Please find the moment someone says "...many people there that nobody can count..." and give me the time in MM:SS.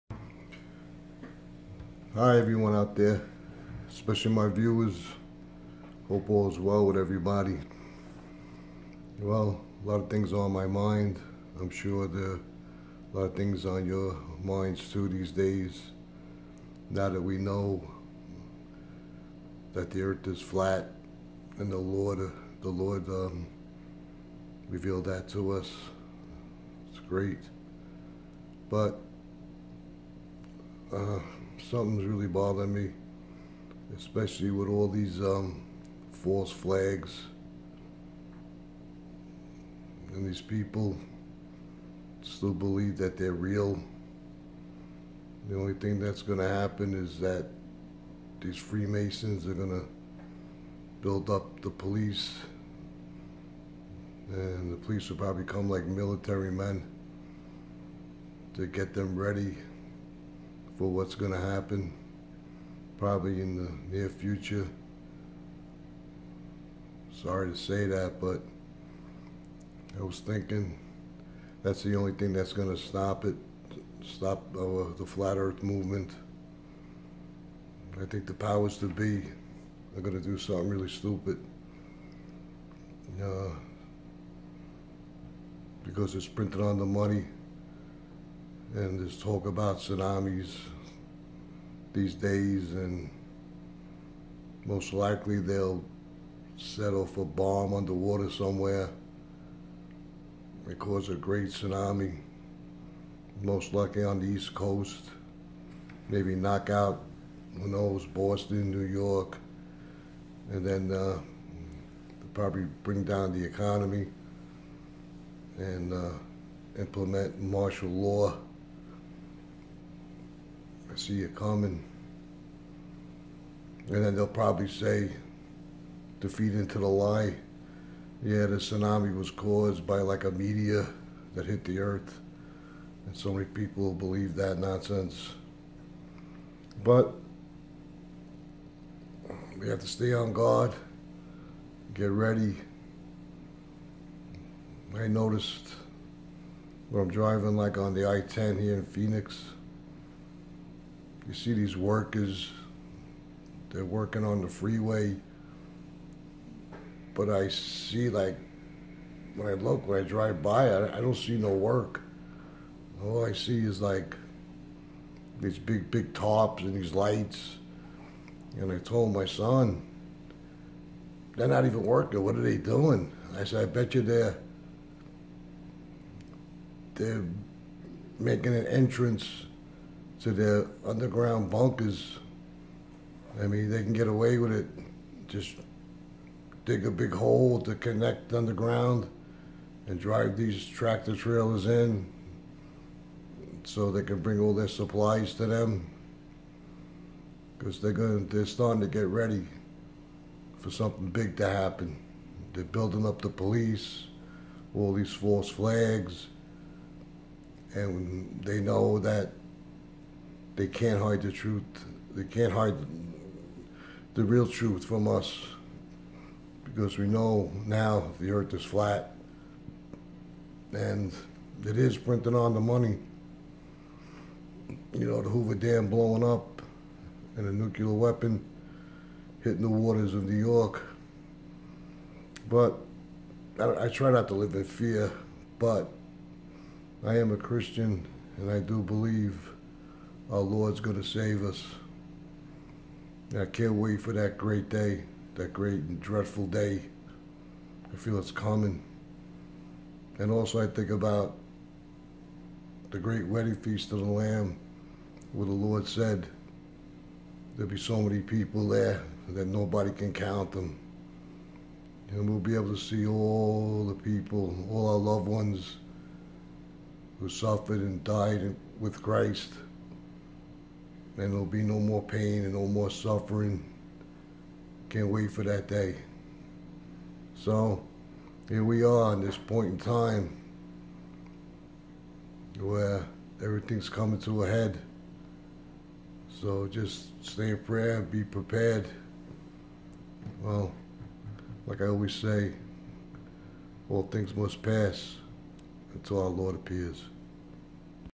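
04:18.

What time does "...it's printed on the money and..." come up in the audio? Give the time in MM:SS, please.
01:26.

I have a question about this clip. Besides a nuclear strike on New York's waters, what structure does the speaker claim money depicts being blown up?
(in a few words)
Hoover Dam.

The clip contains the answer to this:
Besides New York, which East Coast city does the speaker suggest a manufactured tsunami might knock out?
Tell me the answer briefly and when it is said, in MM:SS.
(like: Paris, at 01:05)
Boston, at 01:48.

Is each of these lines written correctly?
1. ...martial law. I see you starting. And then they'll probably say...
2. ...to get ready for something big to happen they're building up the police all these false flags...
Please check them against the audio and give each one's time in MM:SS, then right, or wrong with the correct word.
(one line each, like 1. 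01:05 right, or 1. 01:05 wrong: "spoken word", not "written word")
1. 01:57 wrong: "coming", not "starting"
2. 03:18 right.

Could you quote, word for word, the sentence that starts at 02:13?
And so many people believe that nonsense.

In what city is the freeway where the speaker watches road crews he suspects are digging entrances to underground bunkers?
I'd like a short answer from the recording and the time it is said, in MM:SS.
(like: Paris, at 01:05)
Phoenix, at 02:28.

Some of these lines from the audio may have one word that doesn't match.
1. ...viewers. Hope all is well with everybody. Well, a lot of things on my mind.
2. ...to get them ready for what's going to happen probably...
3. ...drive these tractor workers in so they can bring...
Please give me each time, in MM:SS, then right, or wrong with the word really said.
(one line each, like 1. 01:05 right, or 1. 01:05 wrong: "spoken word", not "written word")
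1. 00:04 right
2. 00:58 right
3. 03:09 wrong: "trailers", not "workers".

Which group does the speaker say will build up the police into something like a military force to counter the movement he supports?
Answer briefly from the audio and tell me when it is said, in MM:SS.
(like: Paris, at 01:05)
Freemasons, at 00:48.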